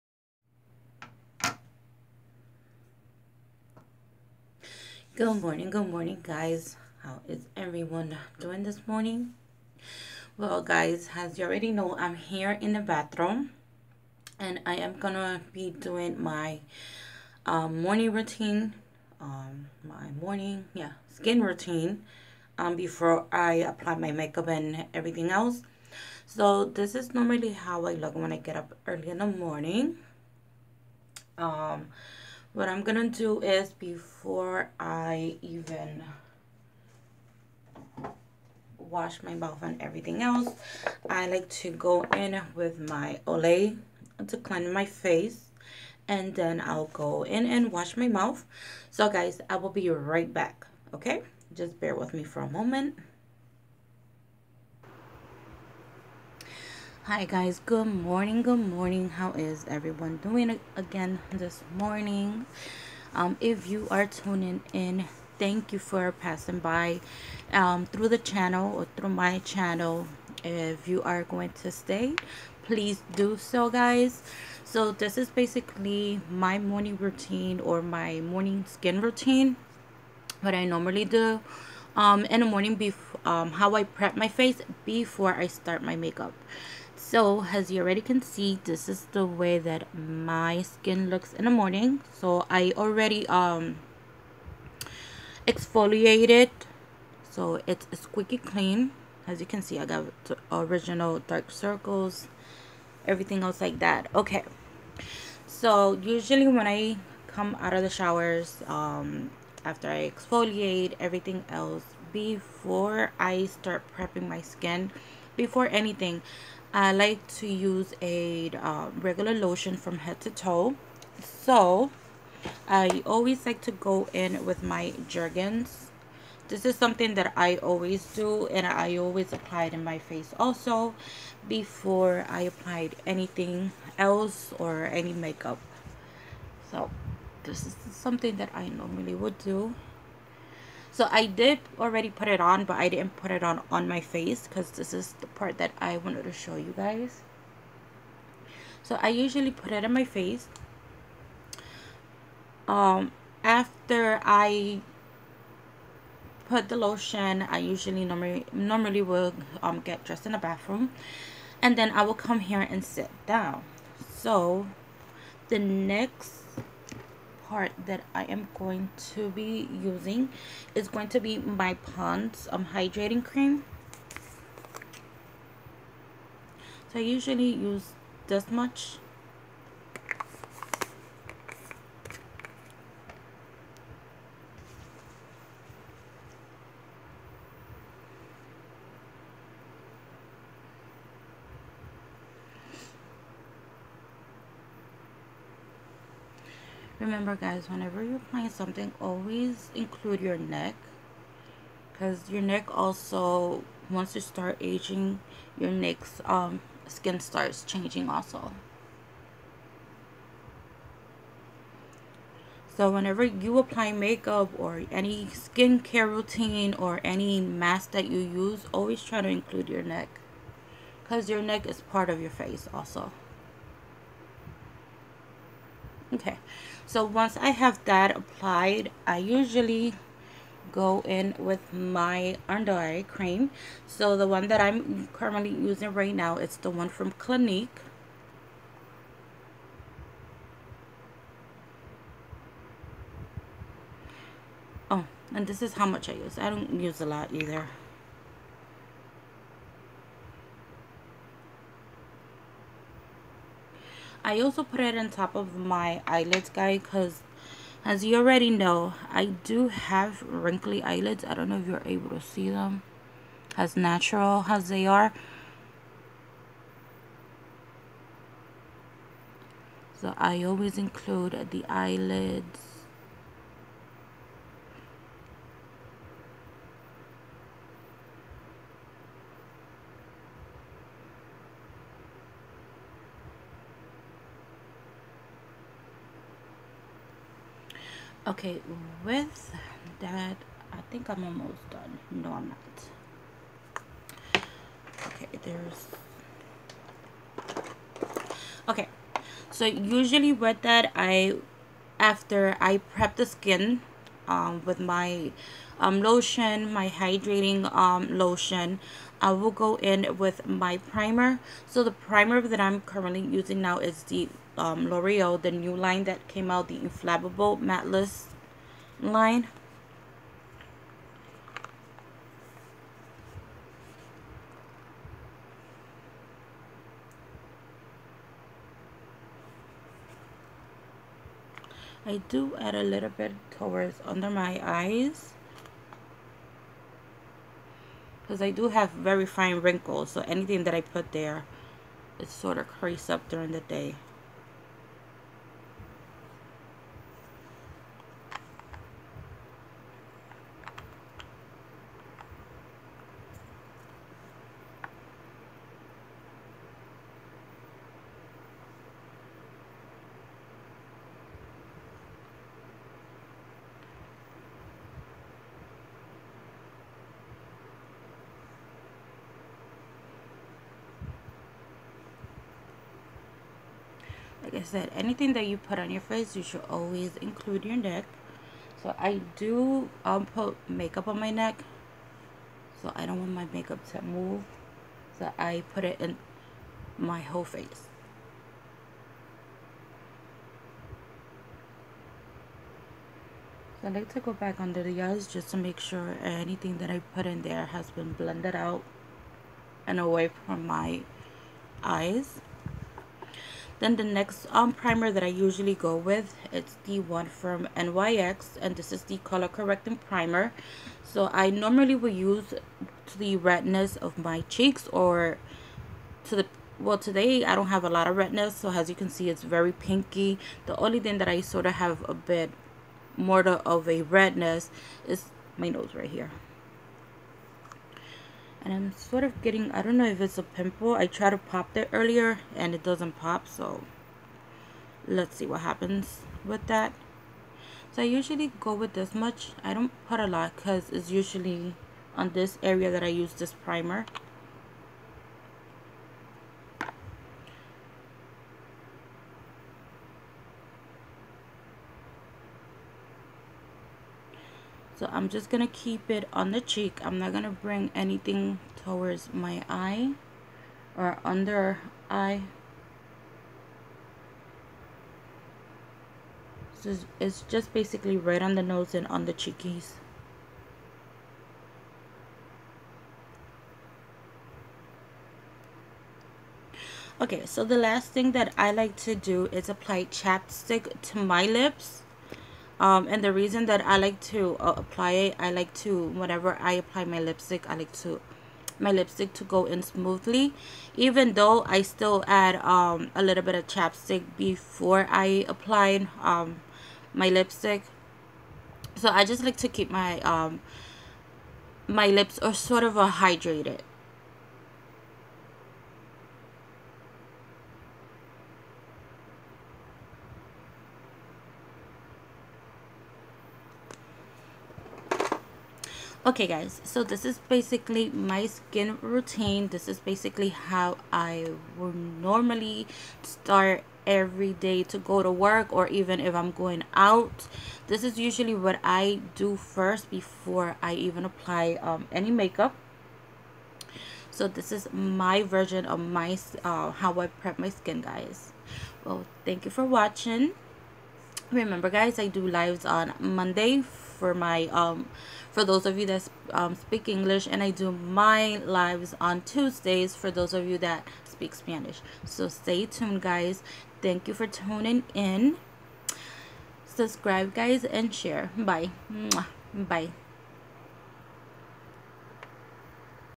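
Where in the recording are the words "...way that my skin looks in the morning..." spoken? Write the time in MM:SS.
01:29.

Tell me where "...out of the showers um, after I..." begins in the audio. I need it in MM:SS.
01:47.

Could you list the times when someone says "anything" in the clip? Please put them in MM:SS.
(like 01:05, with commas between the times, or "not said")
01:55, 02:13, 05:40, 06:14, 06:36, 07:37.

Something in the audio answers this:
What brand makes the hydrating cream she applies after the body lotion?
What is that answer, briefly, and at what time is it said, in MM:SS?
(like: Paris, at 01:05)
Pond's, at 02:51.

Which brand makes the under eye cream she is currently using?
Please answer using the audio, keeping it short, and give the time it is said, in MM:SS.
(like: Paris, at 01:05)
Clinique, at 03:57.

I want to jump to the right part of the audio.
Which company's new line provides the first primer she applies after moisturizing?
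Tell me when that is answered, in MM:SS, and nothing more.
05:14.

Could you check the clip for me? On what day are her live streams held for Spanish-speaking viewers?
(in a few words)
Tuesdays.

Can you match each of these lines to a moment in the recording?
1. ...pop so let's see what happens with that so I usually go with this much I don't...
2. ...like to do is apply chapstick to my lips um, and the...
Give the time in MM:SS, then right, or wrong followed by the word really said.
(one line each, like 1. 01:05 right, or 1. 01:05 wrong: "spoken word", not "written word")
1. 07:13 right
2. 07:58 right.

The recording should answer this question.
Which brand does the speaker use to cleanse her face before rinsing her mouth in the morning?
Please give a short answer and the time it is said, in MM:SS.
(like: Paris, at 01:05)
Olay, at 00:43.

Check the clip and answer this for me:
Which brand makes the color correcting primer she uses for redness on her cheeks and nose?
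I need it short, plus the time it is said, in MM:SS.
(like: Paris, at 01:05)
NYX, at 06:47.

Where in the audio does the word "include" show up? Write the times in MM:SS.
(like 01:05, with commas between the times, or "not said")
03:19, 03:39, 04:30, 06:17.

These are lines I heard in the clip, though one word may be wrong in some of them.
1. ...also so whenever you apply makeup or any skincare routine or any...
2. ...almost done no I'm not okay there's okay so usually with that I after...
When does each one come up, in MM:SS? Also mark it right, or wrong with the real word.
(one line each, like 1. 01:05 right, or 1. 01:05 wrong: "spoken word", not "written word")
1. 03:28 right
2. 04:51 right.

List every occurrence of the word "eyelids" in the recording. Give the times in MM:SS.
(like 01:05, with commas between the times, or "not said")
04:16, 04:20, 04:31.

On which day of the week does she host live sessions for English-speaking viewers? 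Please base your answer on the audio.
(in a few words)
Monday.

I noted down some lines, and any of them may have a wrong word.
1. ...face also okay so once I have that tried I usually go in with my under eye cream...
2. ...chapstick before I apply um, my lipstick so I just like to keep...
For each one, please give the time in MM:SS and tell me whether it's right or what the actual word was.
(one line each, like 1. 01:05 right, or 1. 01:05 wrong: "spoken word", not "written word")
1. 03:42 wrong: "applied", not "tried"
2. 08:13 right.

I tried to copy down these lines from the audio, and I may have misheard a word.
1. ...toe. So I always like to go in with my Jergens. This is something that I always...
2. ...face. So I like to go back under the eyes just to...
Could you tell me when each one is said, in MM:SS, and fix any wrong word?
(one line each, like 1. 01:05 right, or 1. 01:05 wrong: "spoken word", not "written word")
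1. 02:00 right
2. 06:27 right.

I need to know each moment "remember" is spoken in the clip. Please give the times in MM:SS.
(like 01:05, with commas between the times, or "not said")
03:17, 09:01.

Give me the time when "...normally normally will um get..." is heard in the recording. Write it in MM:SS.
02:38.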